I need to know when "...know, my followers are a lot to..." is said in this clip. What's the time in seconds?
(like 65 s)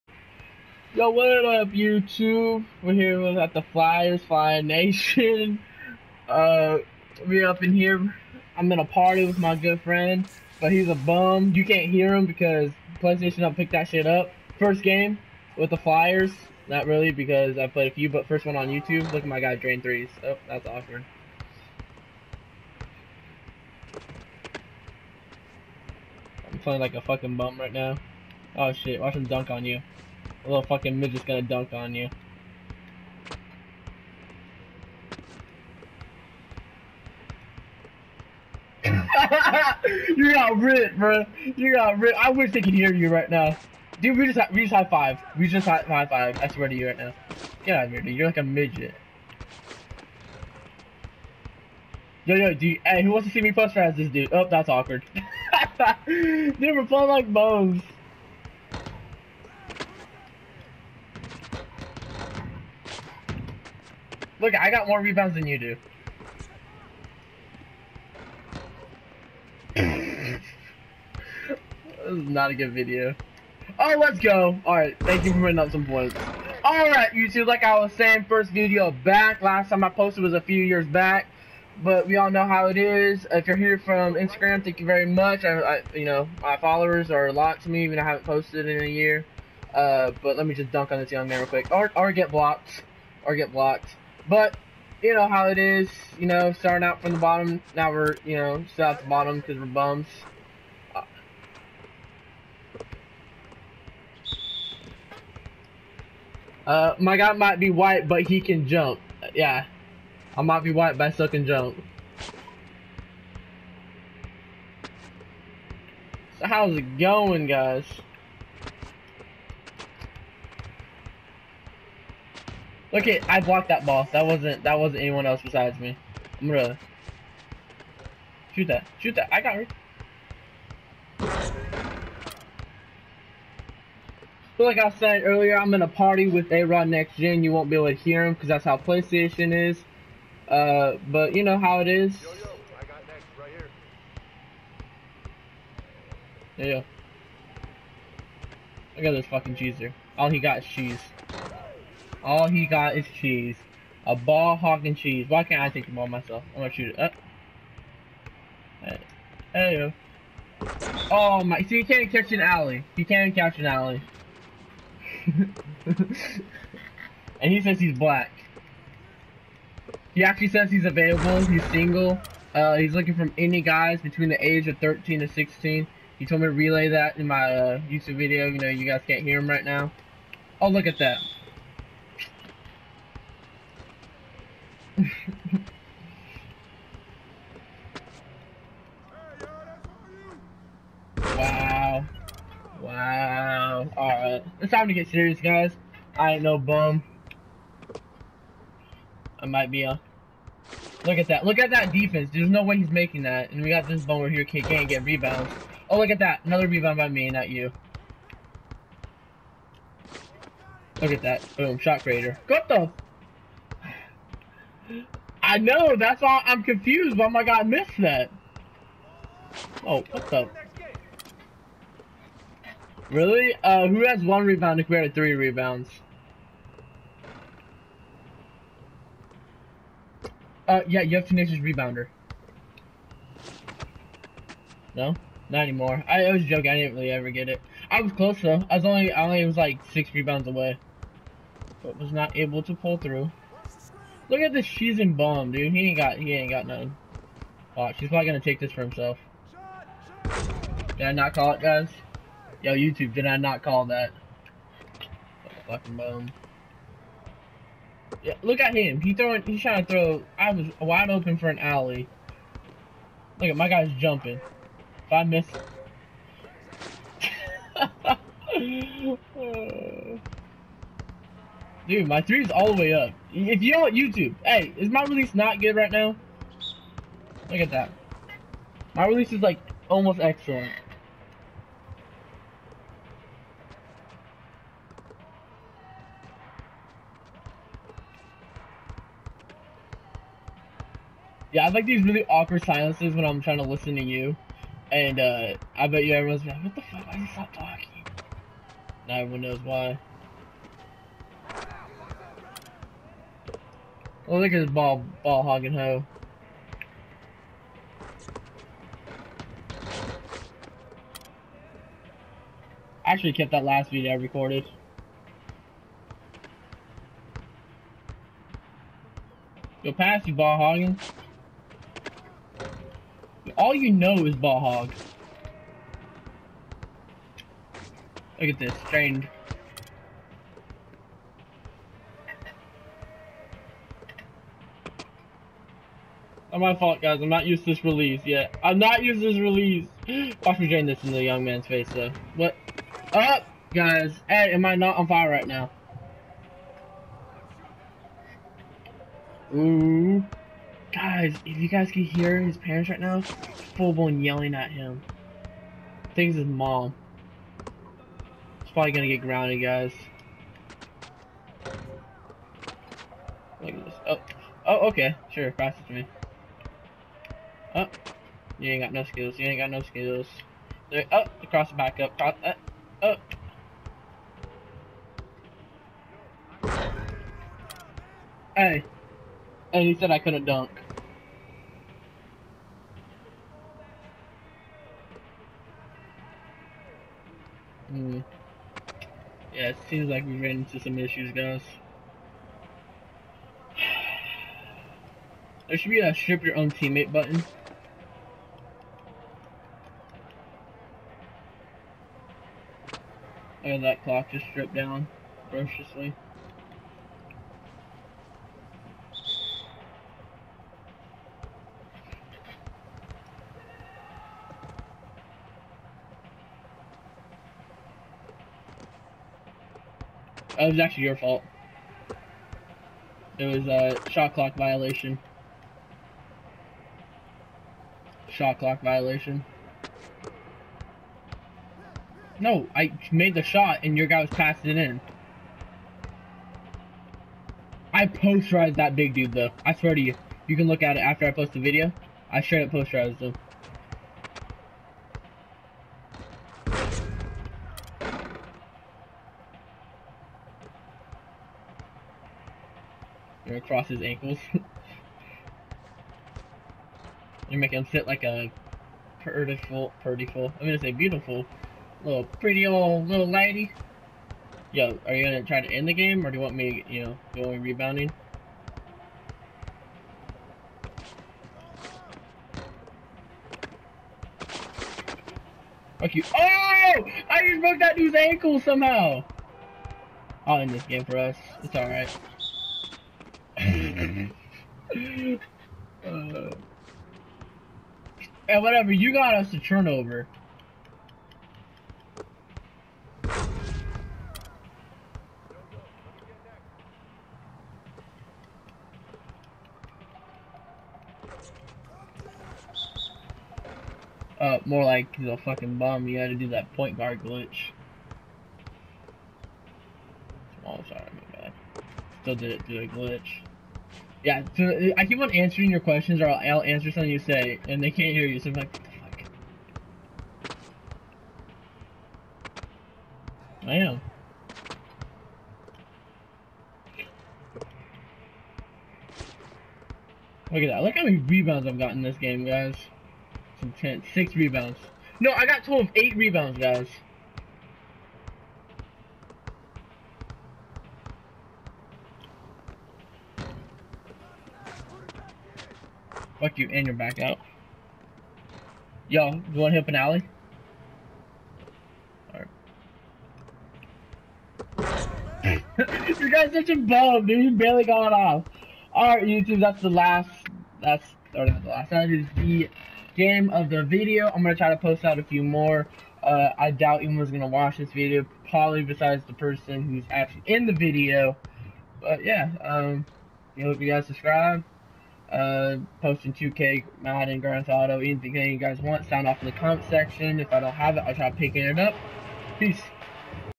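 86 s.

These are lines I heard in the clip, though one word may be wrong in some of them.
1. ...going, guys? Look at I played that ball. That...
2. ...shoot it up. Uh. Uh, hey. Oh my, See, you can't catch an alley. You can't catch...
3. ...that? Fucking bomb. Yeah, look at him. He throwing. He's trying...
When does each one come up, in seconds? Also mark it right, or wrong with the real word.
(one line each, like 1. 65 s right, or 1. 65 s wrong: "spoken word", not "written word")
1. 116 s wrong: "blocked", not "played"
2. 156 s right
3. 253 s right.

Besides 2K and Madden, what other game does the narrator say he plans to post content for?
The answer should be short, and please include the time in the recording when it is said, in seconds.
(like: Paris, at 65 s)
Grand Theft Auto, at 577 s.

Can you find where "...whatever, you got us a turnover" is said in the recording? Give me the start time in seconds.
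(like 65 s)
488 s.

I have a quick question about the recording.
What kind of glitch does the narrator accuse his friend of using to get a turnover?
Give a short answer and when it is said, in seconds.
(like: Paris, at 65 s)
Point guard glitch, at 506 s.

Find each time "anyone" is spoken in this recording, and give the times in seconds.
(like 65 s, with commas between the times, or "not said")
125 s, 567 s.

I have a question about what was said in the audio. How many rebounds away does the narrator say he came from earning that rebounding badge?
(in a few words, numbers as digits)
6.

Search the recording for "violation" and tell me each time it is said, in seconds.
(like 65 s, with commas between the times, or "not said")
424 s, 428 s.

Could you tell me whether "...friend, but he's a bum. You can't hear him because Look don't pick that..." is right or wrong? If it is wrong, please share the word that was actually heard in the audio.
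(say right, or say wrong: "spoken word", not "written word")
wrong: "PlayStation", not "Look".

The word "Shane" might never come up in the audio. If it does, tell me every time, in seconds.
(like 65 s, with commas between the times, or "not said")
not said.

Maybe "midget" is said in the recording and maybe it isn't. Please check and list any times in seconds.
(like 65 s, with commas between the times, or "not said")
30 s, 48 s.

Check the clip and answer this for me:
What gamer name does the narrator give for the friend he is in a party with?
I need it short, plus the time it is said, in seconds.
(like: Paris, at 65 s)
A-Rod Next Gen, at 136 s.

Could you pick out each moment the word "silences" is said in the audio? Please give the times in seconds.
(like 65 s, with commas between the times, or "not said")
292 s.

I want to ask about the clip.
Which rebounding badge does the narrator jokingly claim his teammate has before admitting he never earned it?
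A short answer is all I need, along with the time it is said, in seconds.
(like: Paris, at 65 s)
Tenacious Rebounder, at 231 s.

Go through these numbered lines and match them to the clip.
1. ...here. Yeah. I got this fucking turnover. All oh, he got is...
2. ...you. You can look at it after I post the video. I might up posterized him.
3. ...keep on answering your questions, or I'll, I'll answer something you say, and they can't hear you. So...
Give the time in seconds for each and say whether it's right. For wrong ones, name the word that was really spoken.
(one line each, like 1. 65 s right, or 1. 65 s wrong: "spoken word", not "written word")
1. 146 s wrong: "cheeser", not "turnover"
2. 440 s wrong: "straight", not "might"
3. 515 s right.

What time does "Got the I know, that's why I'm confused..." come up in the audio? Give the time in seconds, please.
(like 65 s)
212 s.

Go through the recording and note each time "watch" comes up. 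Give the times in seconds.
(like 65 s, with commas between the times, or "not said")
28 s, 247 s, 340 s, 567 s.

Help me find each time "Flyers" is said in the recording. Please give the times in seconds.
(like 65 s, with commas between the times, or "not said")
3 s, 15 s.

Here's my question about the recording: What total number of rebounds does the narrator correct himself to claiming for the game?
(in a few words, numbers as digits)
8.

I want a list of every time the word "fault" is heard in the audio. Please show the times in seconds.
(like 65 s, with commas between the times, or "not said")
336 s, 421 s.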